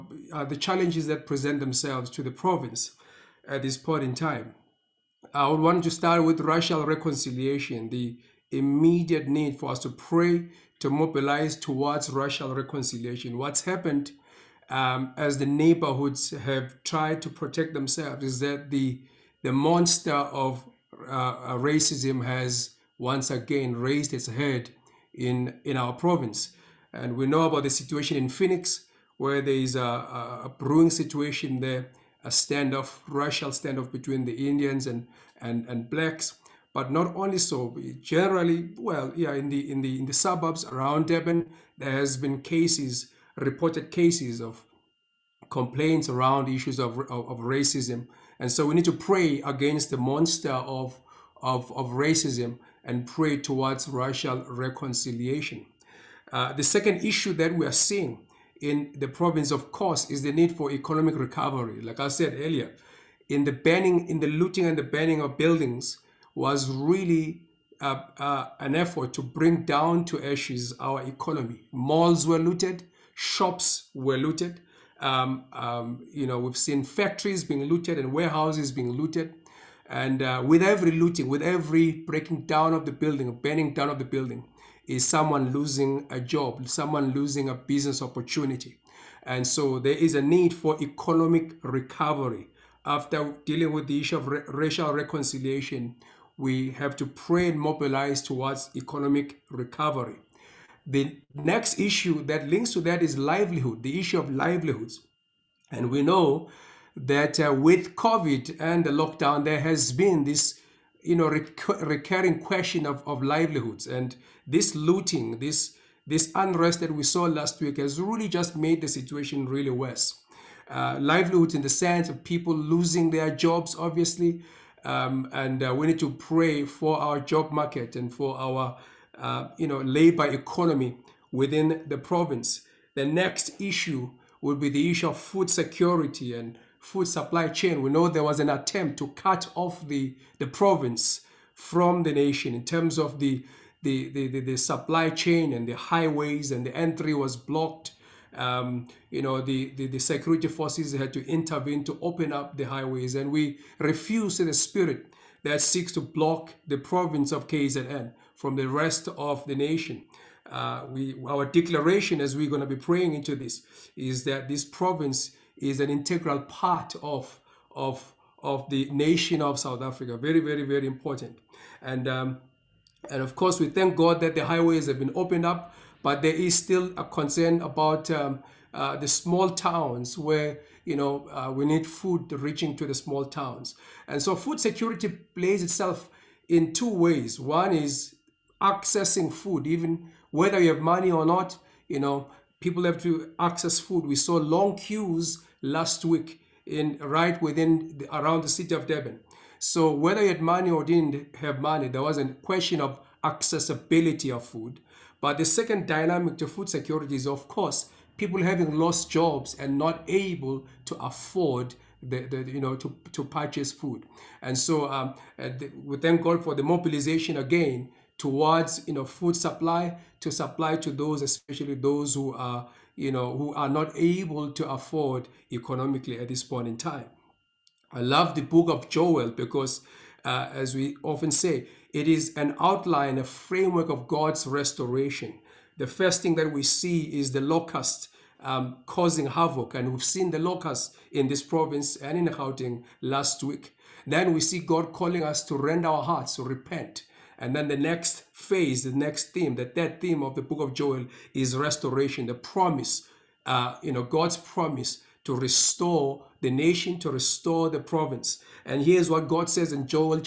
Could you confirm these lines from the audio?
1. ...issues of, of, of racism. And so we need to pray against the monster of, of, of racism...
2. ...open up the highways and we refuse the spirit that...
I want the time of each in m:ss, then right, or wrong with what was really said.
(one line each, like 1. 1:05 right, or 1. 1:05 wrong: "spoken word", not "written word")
1. 0:46 right
2. 2:31 right.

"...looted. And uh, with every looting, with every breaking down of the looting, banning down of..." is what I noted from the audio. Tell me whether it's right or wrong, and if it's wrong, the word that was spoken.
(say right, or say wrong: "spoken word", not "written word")
wrong: "building", not "looting".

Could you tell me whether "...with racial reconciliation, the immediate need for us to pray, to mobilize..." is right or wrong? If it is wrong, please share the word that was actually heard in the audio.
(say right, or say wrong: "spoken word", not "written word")
right.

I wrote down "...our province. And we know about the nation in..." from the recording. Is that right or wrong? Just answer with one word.
wrong.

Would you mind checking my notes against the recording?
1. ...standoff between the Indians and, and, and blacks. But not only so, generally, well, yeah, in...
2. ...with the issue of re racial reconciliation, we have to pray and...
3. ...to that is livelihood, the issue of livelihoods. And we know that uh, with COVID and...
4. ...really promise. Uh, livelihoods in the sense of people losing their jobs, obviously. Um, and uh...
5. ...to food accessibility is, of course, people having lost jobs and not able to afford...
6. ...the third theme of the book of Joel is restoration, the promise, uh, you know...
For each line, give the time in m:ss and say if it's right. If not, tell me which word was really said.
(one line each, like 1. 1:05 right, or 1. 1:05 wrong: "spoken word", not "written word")
1. 0:33 right
2. 1:33 right
3. 1:42 right
4. 1:59 wrong: "worse", not "promise"
5. 3:26 wrong: "security", not "accessibility"
6. 4:09 right.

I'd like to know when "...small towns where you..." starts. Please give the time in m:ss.
2:59.